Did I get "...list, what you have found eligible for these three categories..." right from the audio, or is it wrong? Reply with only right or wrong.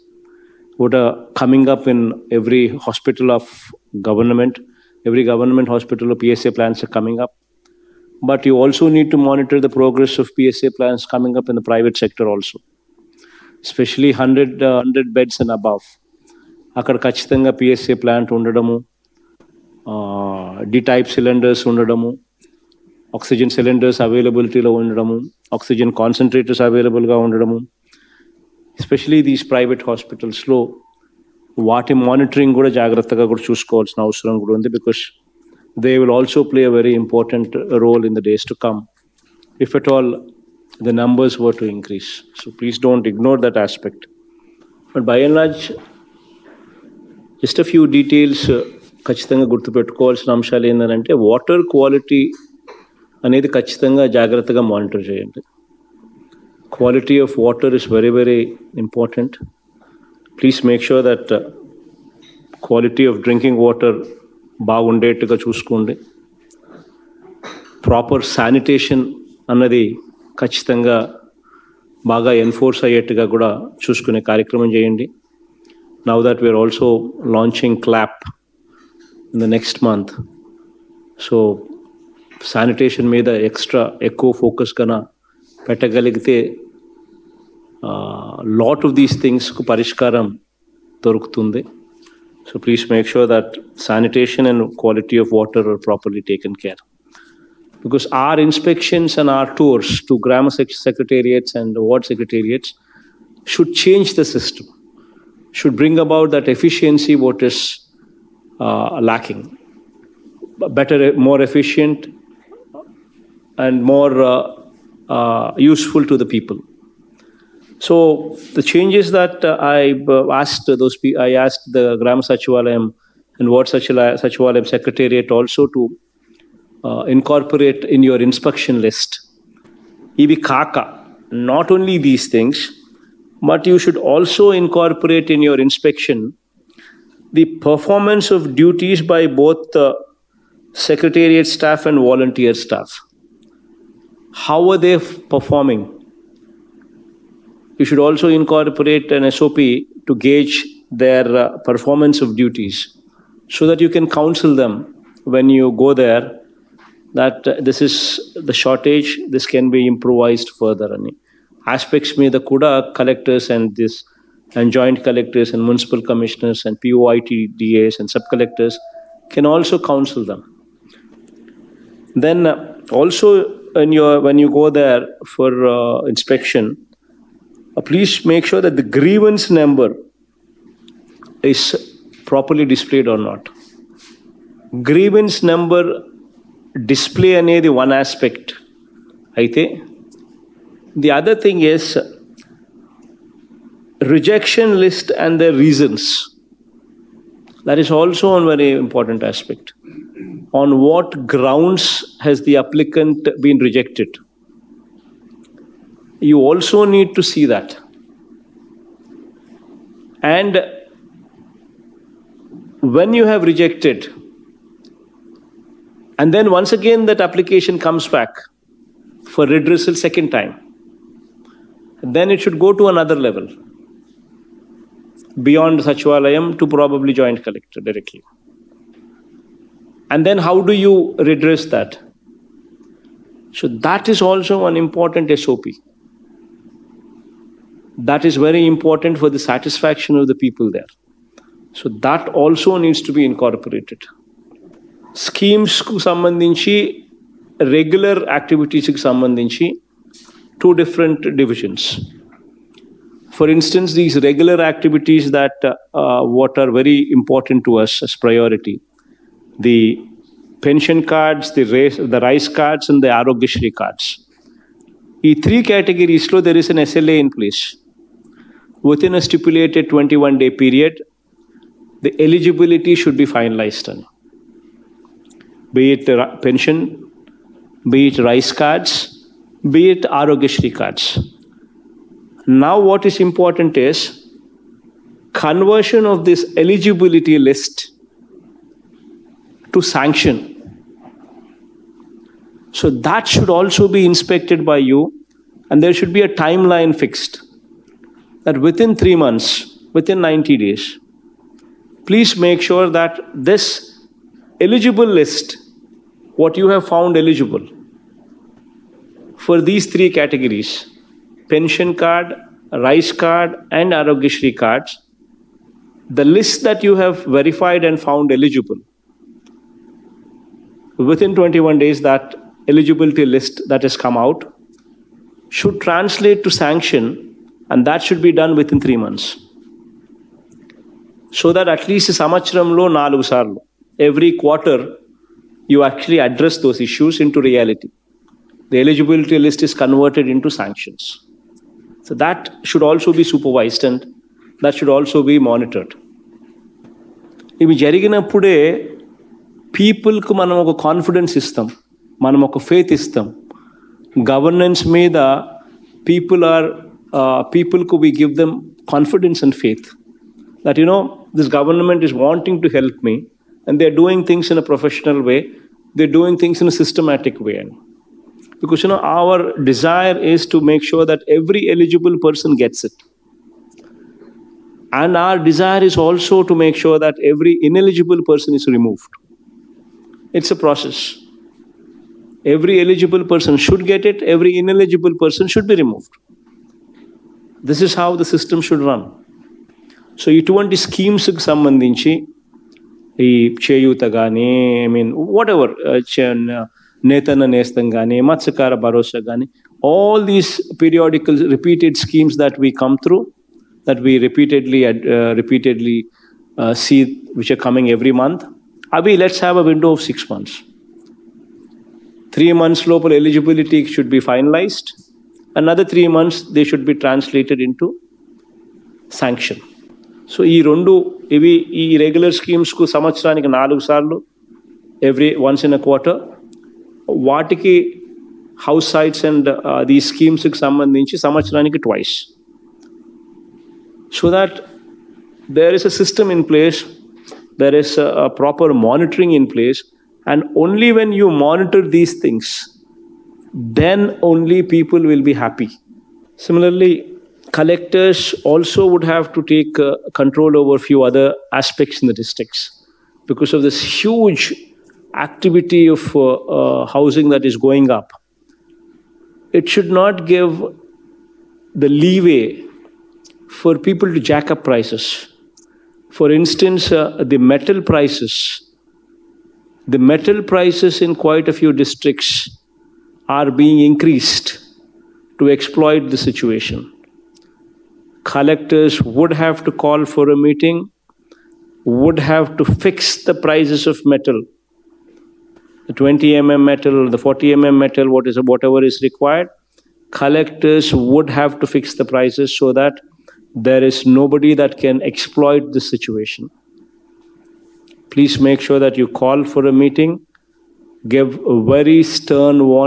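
right.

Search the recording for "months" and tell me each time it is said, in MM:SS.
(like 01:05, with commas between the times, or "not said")
04:59, 05:28, 06:56.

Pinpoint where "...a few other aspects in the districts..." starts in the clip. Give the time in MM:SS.
07:30.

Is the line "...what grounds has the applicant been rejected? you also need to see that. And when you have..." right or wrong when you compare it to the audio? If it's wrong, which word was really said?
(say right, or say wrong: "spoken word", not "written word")
right.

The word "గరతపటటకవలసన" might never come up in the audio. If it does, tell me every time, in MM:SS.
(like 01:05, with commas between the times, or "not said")
00:49.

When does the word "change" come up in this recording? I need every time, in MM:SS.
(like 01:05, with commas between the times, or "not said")
01:43, 01:58.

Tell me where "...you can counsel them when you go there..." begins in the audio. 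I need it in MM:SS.
02:33.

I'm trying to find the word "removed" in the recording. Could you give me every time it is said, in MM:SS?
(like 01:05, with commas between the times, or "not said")
06:18, 06:25.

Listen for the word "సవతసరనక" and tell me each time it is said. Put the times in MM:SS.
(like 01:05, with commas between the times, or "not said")
07:02, 07:11.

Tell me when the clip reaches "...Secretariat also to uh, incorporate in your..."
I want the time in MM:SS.
02:04.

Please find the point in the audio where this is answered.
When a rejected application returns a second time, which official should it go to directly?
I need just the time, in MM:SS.
03:47.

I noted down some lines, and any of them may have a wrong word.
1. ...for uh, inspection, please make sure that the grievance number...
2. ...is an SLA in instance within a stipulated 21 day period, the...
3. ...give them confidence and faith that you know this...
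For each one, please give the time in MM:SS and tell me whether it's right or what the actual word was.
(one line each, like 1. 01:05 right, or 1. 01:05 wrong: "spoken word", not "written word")
1. 02:55 right
2. 04:26 wrong: "place", not "instance"
3. 05:58 right.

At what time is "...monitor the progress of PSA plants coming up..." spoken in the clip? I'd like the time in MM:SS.
00:09.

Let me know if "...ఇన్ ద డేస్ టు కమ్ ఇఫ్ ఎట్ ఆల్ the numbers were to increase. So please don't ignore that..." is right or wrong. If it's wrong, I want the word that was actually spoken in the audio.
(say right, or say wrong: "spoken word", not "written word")
right.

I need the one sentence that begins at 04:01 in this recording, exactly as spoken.
So that also needs to be incorporated.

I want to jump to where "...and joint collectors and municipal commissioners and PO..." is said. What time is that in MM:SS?
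02:44.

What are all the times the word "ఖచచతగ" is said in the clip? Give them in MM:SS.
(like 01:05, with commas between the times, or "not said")
00:17, 00:49, 00:53, 01:10.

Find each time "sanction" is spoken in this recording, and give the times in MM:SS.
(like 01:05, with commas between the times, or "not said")
04:49, 05:26, 05:40.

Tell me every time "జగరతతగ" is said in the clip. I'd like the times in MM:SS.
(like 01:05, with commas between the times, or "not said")
00:32, 00:54.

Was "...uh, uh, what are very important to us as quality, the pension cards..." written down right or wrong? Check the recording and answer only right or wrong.
wrong.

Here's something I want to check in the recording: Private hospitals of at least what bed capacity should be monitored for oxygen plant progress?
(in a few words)
100 beds.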